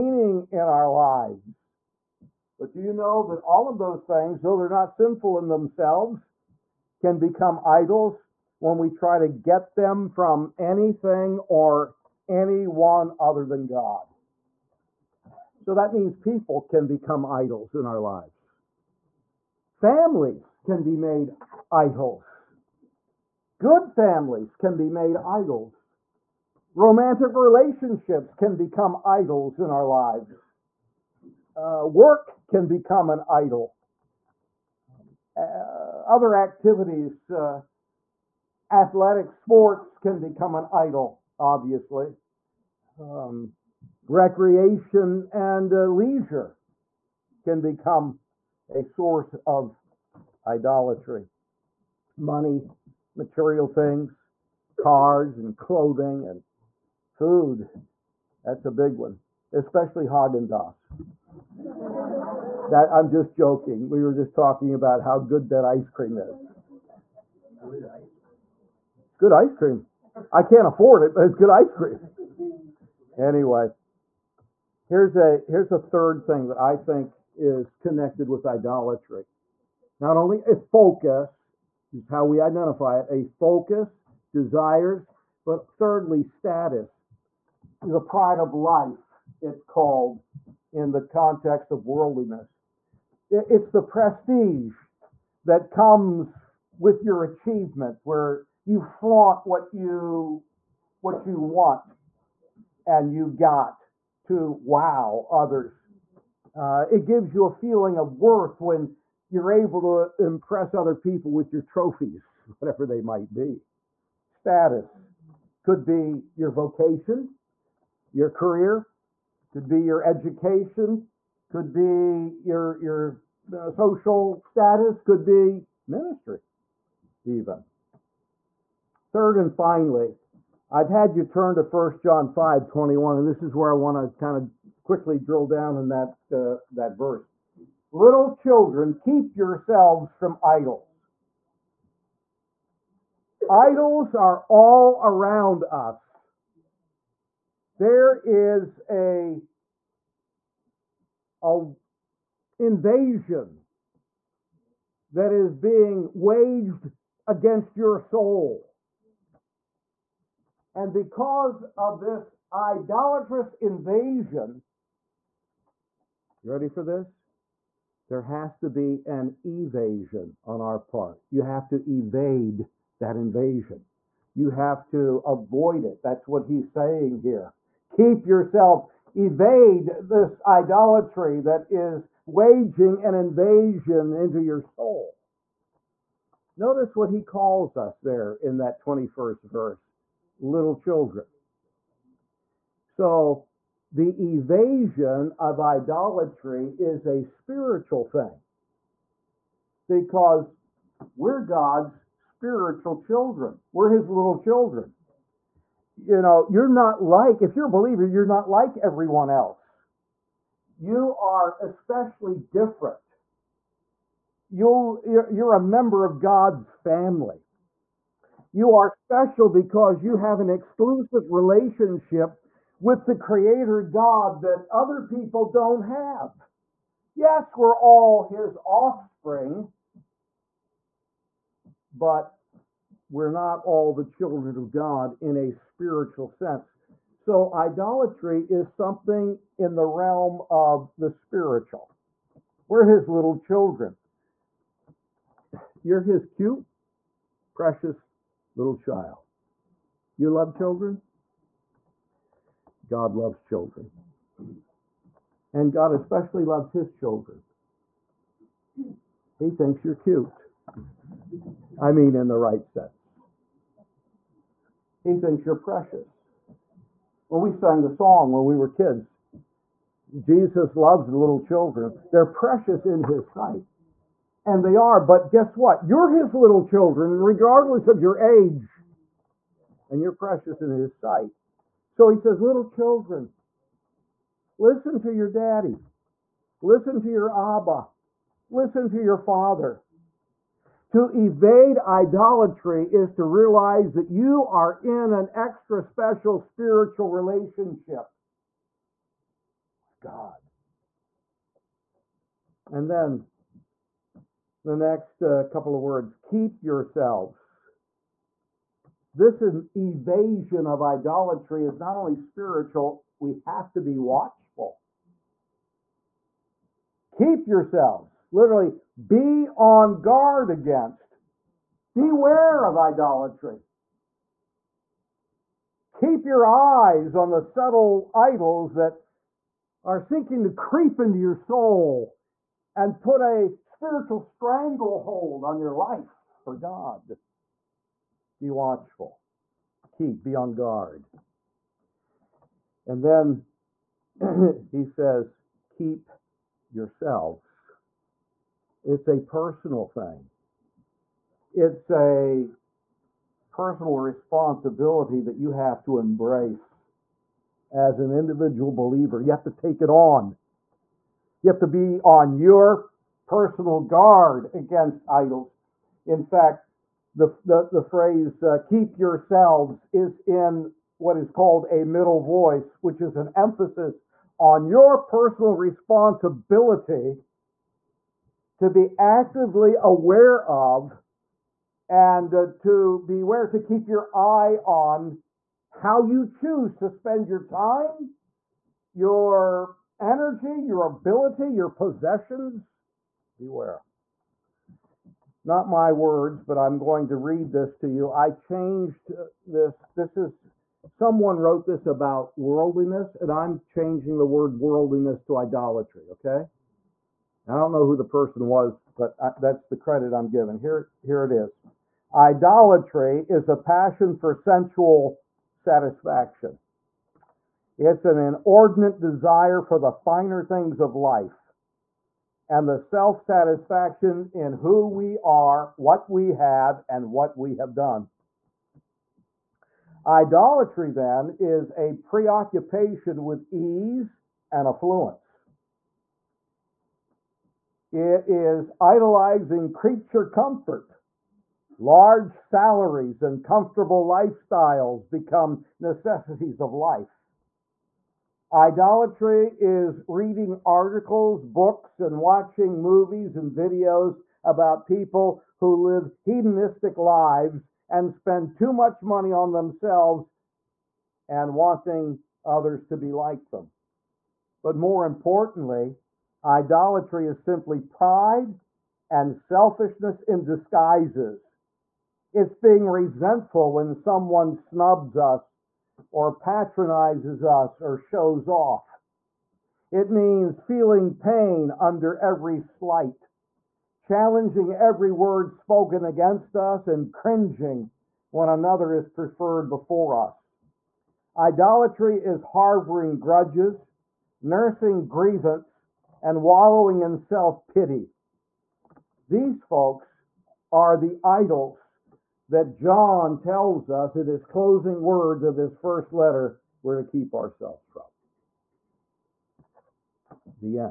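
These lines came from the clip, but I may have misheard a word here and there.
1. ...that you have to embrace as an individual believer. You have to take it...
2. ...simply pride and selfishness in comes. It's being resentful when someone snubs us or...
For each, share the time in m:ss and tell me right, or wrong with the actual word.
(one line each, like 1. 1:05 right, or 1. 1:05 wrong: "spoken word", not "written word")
1. 5:55 right
2. 7:47 wrong: "disguises", not "comes".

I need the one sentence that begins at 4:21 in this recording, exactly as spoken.
I mean, in the right sense.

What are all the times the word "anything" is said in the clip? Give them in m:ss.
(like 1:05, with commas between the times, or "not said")
0:10.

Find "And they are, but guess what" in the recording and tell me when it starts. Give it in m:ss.
4:34.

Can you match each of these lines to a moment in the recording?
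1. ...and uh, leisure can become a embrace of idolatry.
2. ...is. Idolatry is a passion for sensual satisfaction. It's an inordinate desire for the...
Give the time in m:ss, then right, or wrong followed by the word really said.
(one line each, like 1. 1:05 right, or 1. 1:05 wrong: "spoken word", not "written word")
1. 0:45 wrong: "source", not "embrace"
2. 6:51 right.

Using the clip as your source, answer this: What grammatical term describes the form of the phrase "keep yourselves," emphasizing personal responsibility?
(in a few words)
middle voice.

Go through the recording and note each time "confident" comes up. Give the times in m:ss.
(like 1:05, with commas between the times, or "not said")
not said.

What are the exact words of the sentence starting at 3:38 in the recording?
You are special because you have an exclusive relationship with the Creator God that other people don't have.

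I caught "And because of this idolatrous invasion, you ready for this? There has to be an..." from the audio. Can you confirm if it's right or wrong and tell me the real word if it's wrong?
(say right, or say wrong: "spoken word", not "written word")
right.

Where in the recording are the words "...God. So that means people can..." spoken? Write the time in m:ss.
0:13.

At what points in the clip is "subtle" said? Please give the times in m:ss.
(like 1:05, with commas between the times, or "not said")
5:27.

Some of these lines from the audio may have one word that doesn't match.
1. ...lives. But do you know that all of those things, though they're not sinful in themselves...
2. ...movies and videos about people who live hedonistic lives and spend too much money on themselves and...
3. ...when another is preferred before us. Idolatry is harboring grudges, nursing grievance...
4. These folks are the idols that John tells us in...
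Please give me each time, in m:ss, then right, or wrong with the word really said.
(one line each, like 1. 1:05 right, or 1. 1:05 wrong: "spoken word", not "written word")
1. 0:00 right
2. 7:32 right
3. 8:08 right
4. 8:19 right.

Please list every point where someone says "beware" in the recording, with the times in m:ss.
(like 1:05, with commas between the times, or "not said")
5:21, 6:23, 6:33.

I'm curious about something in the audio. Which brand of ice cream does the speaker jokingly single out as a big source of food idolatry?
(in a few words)
Haagen Dazs.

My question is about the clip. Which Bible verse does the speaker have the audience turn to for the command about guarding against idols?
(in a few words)
First John 5:21.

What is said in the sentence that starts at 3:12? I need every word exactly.
So the evasion of idolatry is a spiritual thing because we're God's spiritual children, we're his little children.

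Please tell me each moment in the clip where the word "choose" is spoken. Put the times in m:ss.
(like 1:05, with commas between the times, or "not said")
6:26.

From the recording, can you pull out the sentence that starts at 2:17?
Little children, keep yourselves from idols.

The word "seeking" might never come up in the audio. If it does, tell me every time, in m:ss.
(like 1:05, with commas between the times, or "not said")
5:29.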